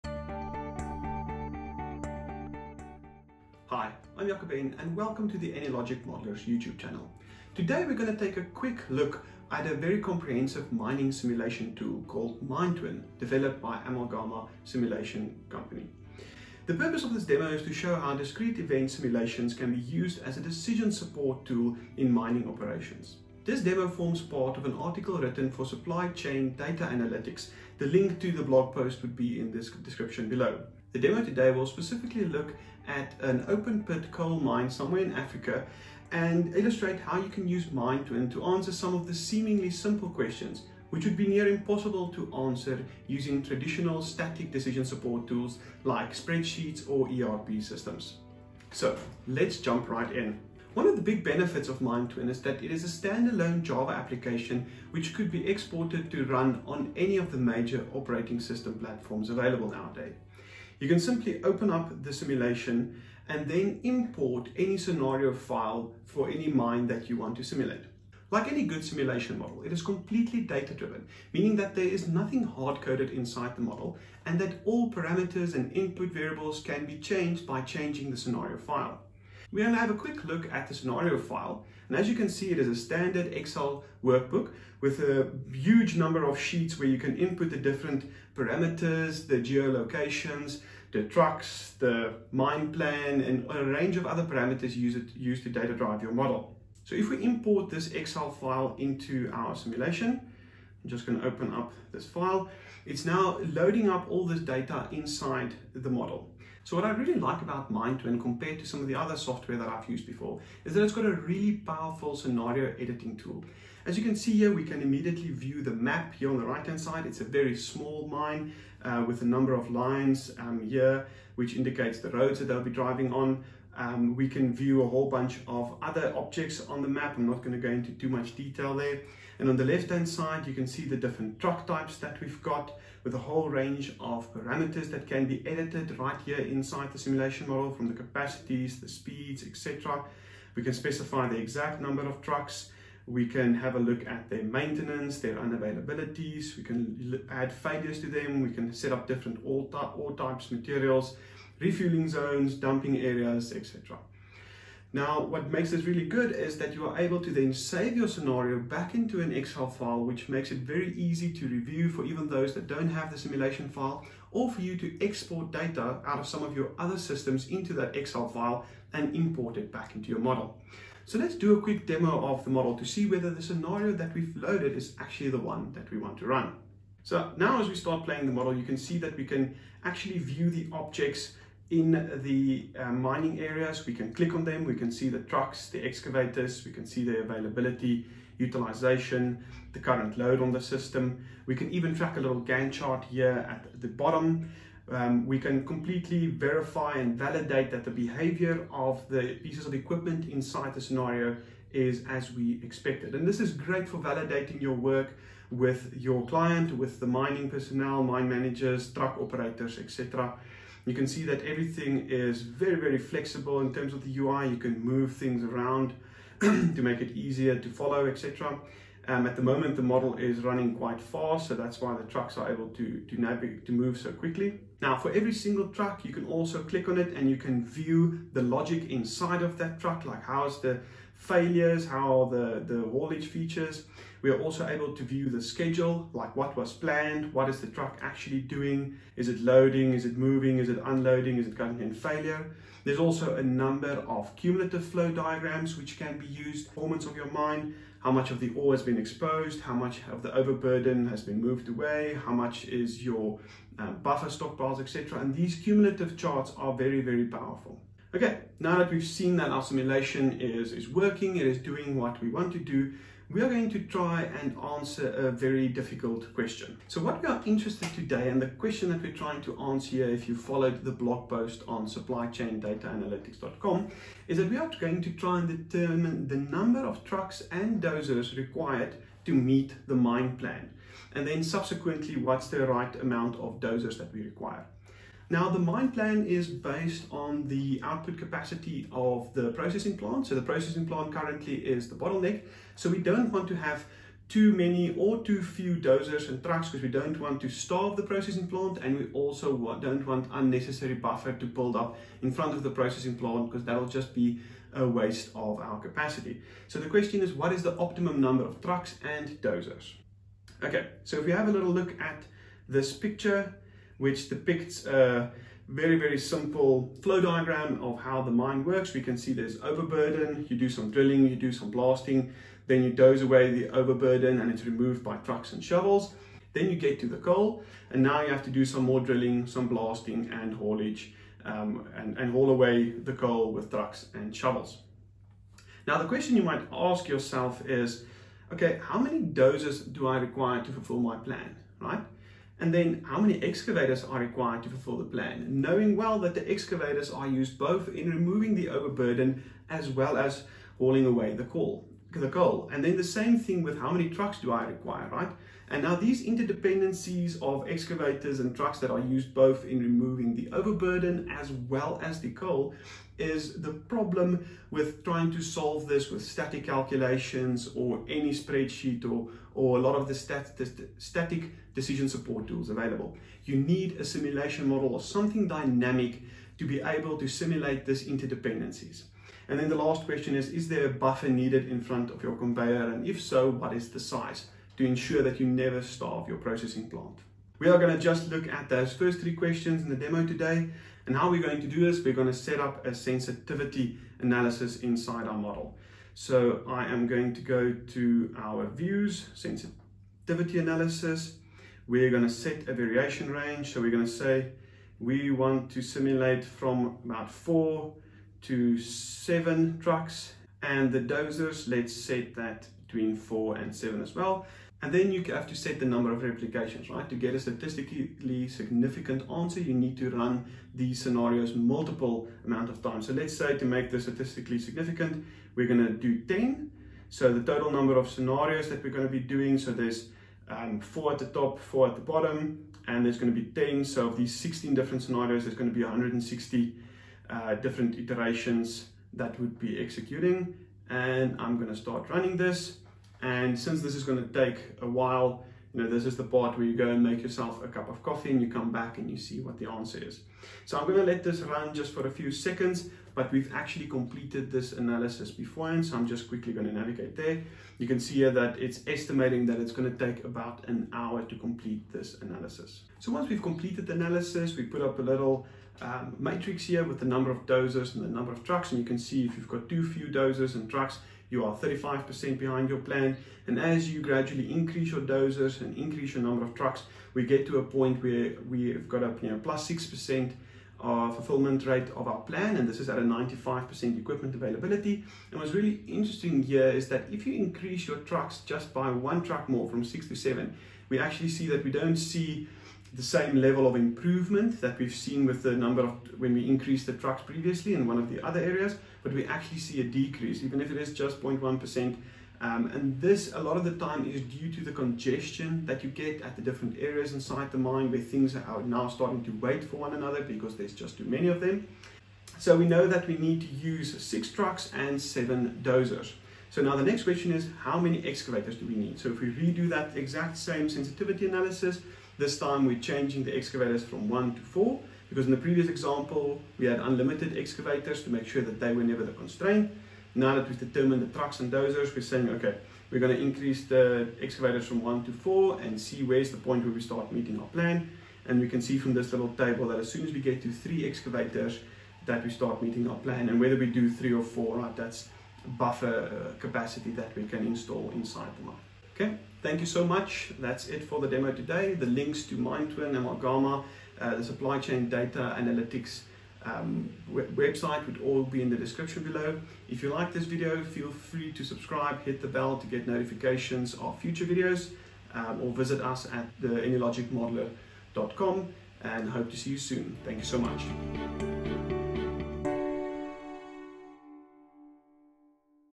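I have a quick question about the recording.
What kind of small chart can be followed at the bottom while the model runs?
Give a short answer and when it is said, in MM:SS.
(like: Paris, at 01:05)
Gantt chart, at 03:12.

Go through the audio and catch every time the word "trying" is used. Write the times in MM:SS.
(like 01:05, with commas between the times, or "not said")
04:29, 06:05.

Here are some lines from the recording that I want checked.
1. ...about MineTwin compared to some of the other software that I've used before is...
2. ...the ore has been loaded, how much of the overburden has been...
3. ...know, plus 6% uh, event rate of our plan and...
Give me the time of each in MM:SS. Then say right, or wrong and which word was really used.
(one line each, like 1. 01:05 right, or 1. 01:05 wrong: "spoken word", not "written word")
1. 01:47 right
2. 04:08 wrong: "exposed", not "loaded"
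3. 07:59 wrong: "fulfillment", not "event".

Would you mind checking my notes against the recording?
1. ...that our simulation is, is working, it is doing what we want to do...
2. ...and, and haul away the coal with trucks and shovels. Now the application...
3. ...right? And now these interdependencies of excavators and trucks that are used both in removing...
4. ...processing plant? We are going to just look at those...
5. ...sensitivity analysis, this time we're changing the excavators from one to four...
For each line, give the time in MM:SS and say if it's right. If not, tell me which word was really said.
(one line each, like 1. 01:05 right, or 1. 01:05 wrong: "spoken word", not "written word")
1. 04:19 right
2. 05:31 wrong: "question", not "application"
3. 05:55 right
4. 06:26 right
5. 08:40 right.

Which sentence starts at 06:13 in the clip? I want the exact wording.
You need a simulation model or something dynamic to be able to simulate this interdependencies.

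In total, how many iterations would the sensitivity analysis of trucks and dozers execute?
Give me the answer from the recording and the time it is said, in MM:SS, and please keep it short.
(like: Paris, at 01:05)
160, at 07:15.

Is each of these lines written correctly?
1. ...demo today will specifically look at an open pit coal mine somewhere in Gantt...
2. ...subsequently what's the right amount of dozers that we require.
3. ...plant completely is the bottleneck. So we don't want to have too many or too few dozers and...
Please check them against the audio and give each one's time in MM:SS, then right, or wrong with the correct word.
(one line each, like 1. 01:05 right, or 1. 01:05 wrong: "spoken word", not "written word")
1. 00:30 wrong: "Africa", not "Gantt"
2. 04:41 right
3. 04:50 wrong: "currently", not "completely".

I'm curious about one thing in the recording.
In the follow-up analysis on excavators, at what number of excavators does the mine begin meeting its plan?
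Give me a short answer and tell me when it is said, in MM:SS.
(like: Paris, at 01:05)
3, at 09:00.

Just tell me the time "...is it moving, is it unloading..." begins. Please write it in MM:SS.
03:59.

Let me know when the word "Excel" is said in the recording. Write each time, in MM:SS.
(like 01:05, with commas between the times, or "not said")
01:23, 01:37, 02:39, 02:47.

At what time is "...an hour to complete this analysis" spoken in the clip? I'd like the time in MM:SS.
07:40.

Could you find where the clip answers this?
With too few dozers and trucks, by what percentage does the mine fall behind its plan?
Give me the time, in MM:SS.
07:51.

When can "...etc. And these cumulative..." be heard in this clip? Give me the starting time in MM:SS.
04:14.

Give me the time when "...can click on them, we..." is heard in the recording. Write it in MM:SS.
03:03.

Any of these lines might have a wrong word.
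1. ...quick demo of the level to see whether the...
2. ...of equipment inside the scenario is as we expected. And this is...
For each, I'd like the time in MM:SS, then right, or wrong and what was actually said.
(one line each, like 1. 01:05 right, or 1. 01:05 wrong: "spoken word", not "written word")
1. 02:51 wrong: "model", not "level"
2. 03:19 right.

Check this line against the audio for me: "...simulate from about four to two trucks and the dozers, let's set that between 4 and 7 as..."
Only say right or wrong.
wrong.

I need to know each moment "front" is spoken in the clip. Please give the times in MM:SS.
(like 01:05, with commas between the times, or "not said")
05:02, 06:21.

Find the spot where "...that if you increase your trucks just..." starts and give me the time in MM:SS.
08:06.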